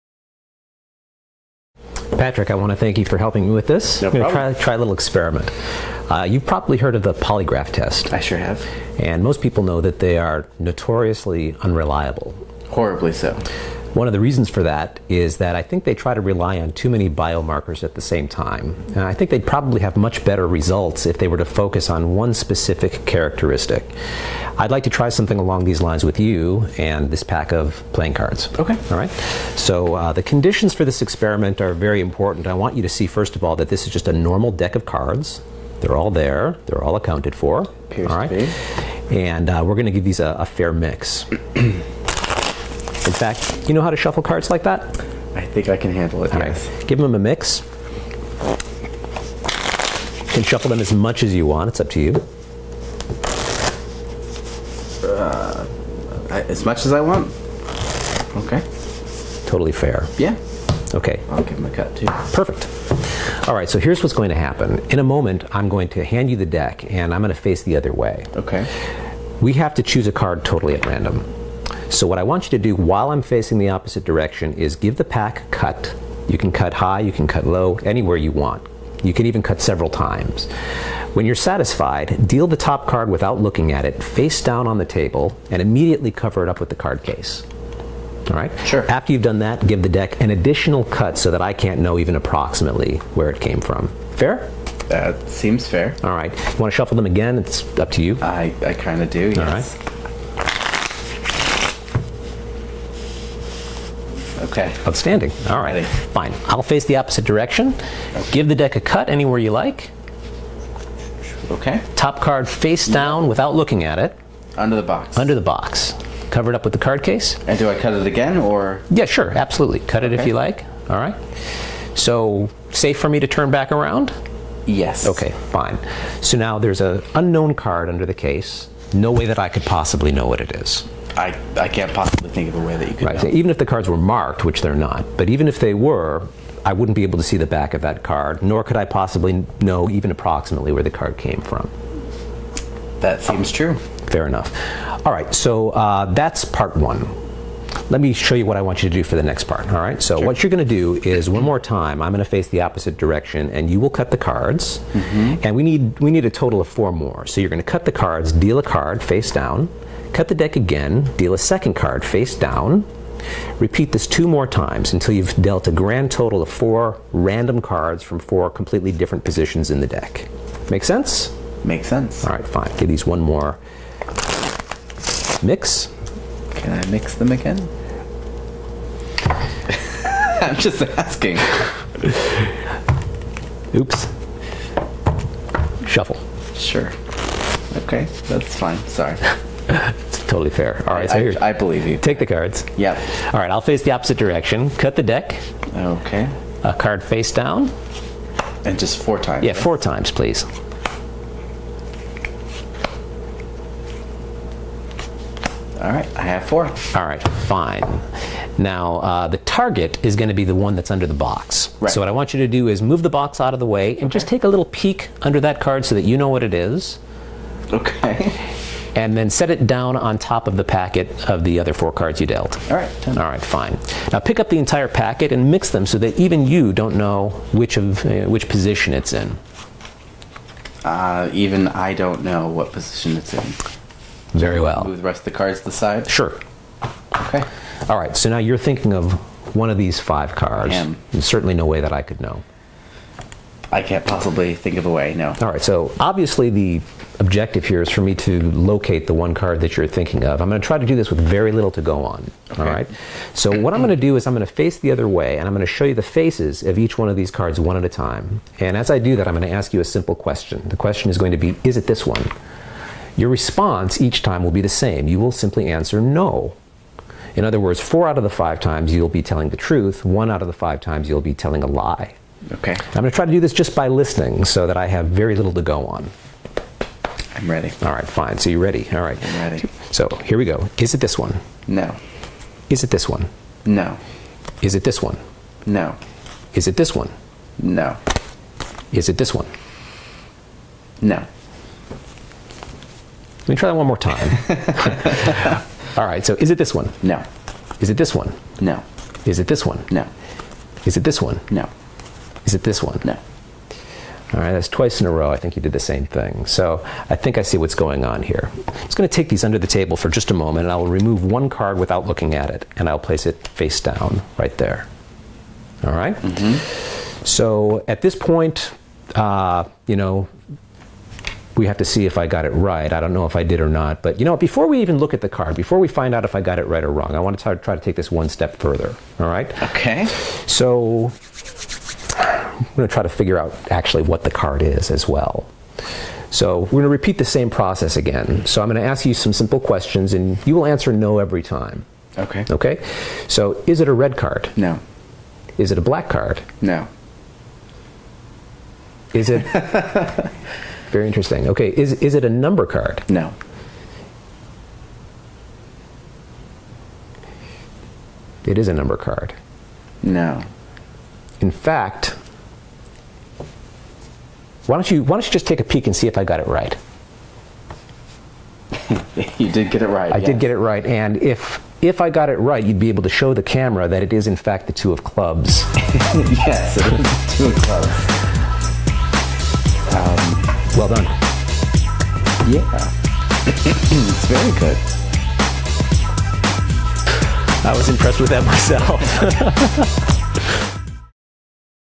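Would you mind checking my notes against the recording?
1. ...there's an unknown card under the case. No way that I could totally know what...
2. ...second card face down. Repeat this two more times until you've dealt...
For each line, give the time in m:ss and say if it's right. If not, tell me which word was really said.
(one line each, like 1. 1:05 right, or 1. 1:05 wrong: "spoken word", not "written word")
1. 2:06 wrong: "possibly", not "totally"
2. 2:41 right.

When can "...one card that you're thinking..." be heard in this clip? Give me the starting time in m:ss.
4:09.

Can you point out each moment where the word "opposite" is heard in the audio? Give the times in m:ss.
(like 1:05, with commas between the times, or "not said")
1:13, 1:46, 2:32, 3:13.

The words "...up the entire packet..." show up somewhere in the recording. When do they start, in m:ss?
3:44.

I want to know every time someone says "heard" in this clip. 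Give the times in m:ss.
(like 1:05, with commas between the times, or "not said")
0:06.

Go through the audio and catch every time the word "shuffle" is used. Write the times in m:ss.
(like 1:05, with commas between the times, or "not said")
0:43, 0:50, 1:36, 3:05.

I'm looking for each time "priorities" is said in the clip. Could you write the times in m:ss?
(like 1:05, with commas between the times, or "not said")
not said.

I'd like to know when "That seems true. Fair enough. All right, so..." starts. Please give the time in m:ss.
2:23.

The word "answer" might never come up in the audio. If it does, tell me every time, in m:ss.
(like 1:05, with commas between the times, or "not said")
4:25, 5:40.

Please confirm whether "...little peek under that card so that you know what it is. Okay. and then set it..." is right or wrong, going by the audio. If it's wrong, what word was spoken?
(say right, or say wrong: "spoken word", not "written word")
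right.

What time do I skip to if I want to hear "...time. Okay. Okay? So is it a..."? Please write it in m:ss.
5:41.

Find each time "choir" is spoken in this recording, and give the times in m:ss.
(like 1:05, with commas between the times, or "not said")
not said.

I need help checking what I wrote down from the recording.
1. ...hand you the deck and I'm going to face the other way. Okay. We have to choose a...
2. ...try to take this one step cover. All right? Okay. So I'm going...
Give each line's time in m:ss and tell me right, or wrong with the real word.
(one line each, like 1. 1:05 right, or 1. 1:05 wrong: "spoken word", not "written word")
1. 1:06 right
2. 5:27 wrong: "further", not "cover".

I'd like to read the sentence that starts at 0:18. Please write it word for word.
And I think they'd probably have much better results if they were to focus on one specific characteristic.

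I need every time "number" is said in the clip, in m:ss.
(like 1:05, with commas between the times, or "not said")
5:52, 5:58.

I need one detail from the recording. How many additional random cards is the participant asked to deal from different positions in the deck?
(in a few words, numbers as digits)
4.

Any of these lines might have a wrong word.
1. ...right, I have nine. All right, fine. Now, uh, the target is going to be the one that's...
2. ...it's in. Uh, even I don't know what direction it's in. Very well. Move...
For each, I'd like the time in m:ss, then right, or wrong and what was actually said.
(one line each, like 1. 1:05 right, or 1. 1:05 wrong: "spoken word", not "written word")
1. 3:25 wrong: "four", not "nine"
2. 3:48 wrong: "position", not "direction".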